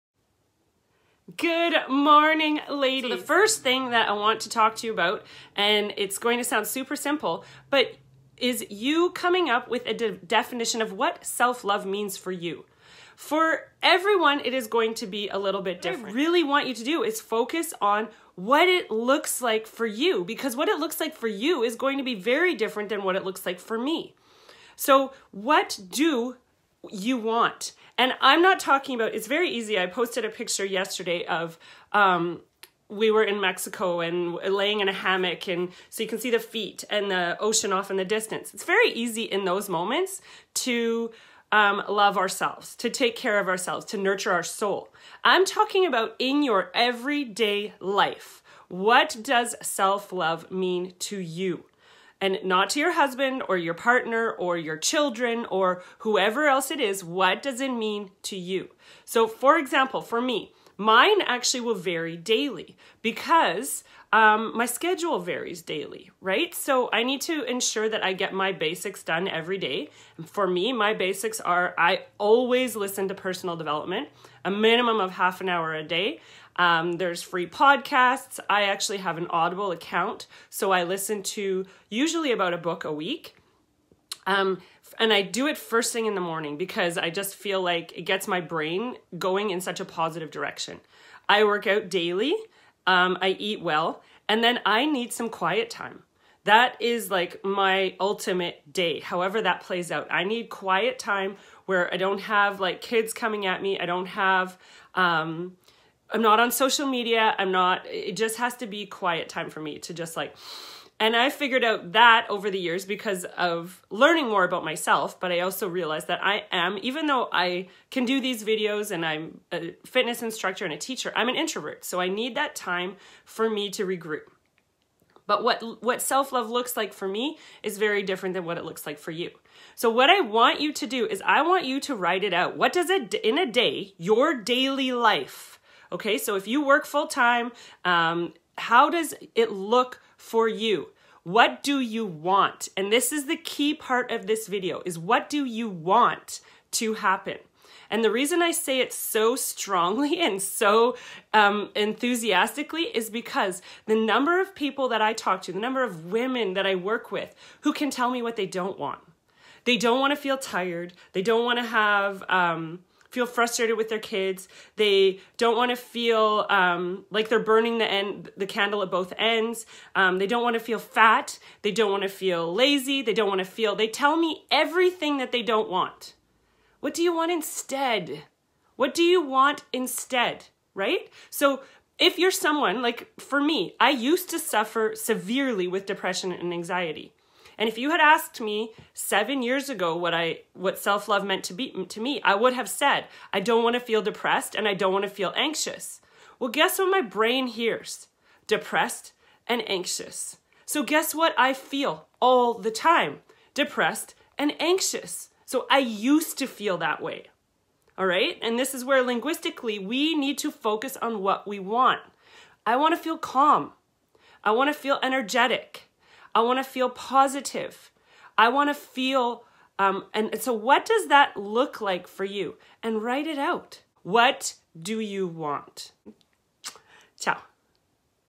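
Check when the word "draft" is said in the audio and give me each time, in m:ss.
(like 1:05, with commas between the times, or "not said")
not said.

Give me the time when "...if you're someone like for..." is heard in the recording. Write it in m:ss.
3:01.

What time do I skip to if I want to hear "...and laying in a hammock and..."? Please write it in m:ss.
0:33.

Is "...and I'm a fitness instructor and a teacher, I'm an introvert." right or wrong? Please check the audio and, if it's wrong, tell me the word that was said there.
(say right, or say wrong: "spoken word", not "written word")
right.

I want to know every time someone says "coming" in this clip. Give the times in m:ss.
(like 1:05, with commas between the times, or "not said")
0:09, 1:43.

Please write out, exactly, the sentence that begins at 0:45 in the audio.
I'm talking about in your everyday life.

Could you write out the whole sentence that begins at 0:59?
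So, for example, for me, mine actually will vary daily because um, my schedule varies daily, right?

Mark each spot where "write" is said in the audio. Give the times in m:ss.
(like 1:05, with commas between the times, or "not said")
2:11, 3:43.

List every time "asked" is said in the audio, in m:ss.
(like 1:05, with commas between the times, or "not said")
3:08.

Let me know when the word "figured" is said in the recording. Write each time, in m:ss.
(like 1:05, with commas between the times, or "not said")
1:51.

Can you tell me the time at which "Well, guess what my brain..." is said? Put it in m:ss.
3:16.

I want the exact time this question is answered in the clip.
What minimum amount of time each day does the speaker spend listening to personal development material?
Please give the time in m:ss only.
1:15.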